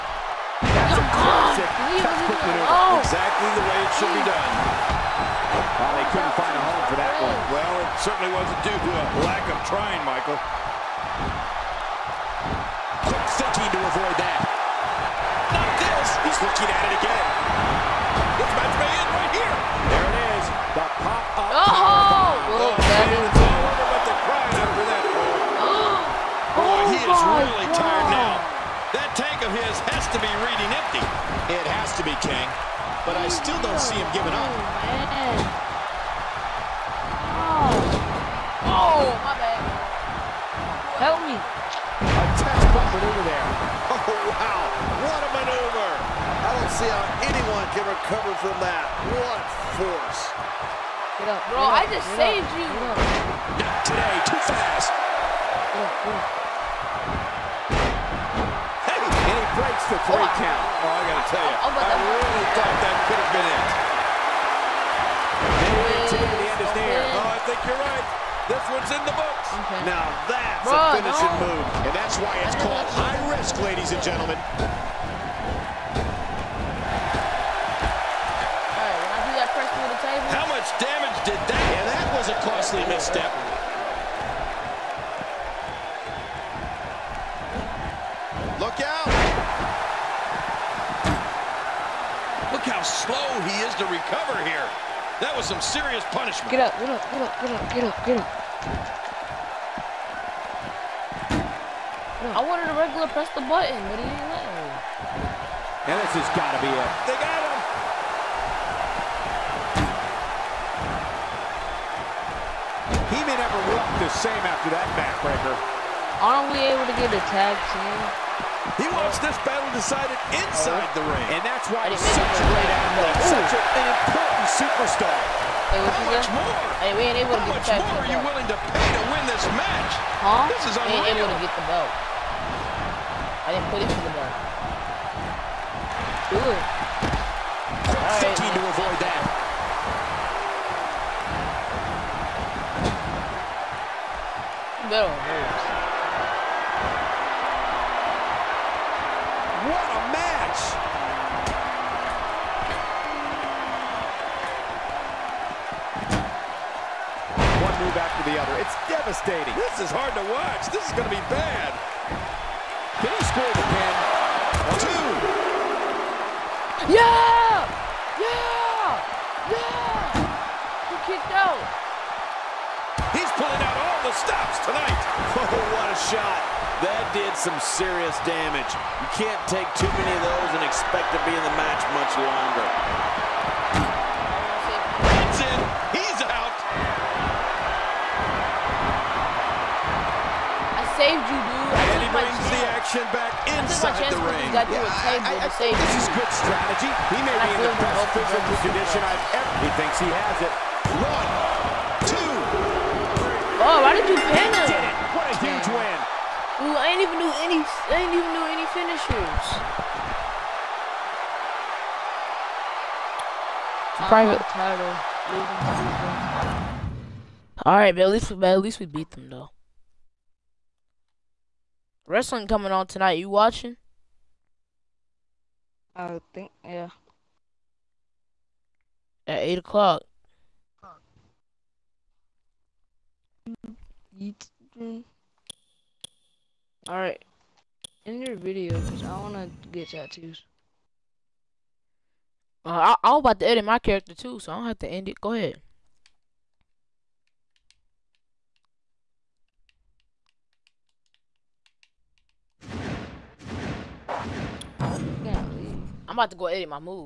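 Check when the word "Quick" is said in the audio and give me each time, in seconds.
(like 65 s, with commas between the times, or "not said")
13 s, 136 s.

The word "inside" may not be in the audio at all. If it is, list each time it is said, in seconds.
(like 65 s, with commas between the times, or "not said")
120 s, 193 s.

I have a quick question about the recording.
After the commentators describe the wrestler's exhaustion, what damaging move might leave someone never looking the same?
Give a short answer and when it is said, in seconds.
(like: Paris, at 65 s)
backbreaker, at 114 s.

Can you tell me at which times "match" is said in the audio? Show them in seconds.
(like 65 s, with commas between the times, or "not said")
18 s, 129 s, 150 s, 181 s.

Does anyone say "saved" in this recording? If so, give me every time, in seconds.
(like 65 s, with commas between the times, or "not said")
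52 s, 190 s.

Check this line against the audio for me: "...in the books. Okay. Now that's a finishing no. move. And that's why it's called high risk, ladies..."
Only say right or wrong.
right.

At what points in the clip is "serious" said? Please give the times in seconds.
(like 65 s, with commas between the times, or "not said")
95 s, 177 s.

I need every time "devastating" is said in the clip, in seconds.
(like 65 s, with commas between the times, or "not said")
158 s.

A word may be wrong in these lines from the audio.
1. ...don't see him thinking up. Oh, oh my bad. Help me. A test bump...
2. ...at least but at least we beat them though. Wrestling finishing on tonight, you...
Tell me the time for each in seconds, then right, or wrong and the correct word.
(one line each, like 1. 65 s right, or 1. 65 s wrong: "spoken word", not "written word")
1. 33 s wrong: "giving", not "thinking"
2. 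218 s wrong: "coming", not "finishing".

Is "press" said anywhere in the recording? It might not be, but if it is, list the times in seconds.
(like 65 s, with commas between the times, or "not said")
103 s.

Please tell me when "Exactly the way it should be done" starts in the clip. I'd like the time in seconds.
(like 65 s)
3 s.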